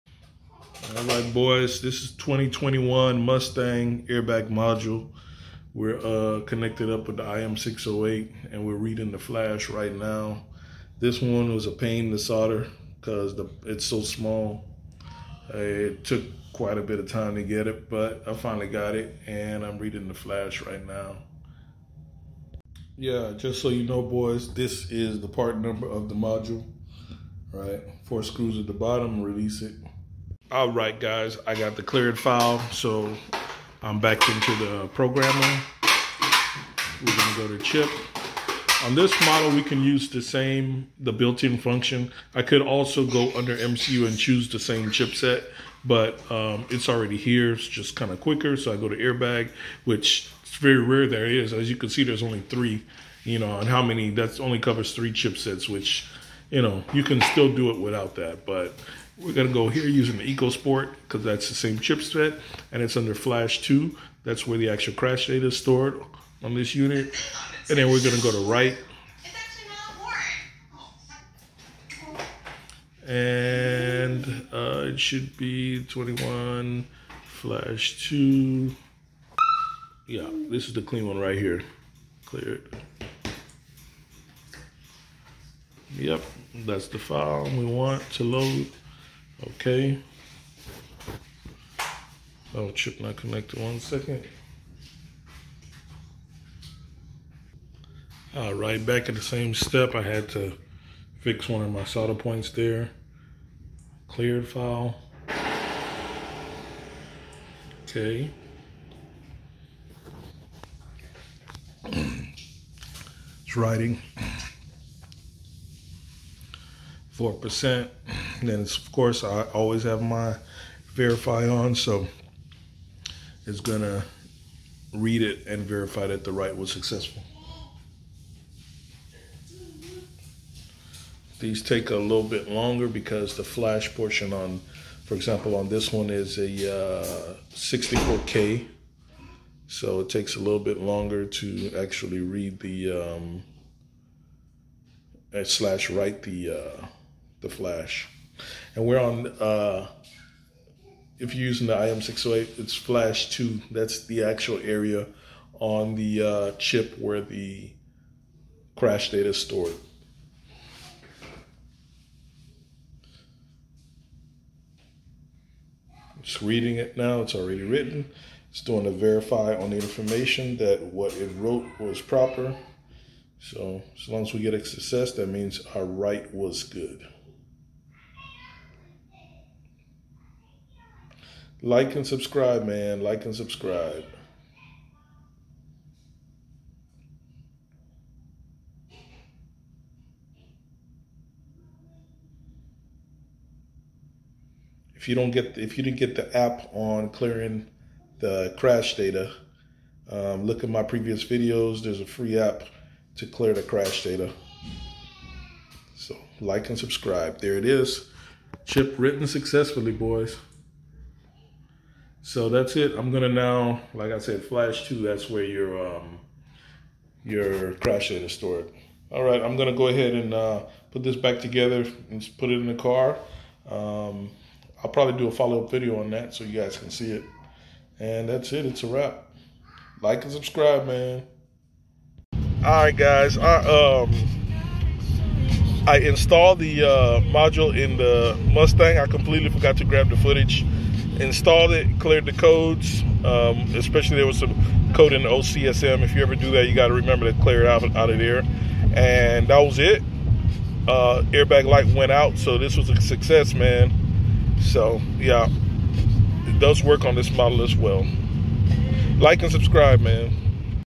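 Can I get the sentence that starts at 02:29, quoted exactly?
Uh, if you're using the IM608, it's Flash 2.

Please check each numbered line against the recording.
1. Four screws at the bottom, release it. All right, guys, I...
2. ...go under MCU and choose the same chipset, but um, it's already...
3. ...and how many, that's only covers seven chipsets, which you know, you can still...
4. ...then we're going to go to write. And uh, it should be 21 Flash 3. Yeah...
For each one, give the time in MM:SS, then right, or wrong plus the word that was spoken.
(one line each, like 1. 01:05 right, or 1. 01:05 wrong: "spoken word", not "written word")
1. 00:28 right
2. 00:43 right
3. 00:53 wrong: "three", not "seven"
4. 01:07 wrong: "2", not "3".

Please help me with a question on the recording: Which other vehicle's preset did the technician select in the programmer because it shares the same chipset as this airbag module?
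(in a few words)
EcoSport.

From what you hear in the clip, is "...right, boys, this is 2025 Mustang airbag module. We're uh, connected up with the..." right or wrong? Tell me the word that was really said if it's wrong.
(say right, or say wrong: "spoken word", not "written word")
wrong: "2021", not "2025".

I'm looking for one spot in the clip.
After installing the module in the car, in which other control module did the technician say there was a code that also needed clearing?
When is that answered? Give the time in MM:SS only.
04:05.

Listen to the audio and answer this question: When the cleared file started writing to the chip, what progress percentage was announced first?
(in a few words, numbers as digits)
4%.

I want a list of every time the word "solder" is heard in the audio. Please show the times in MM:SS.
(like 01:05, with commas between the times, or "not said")
00:12, 01:41.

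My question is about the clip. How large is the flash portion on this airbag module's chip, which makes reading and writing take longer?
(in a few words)
64K.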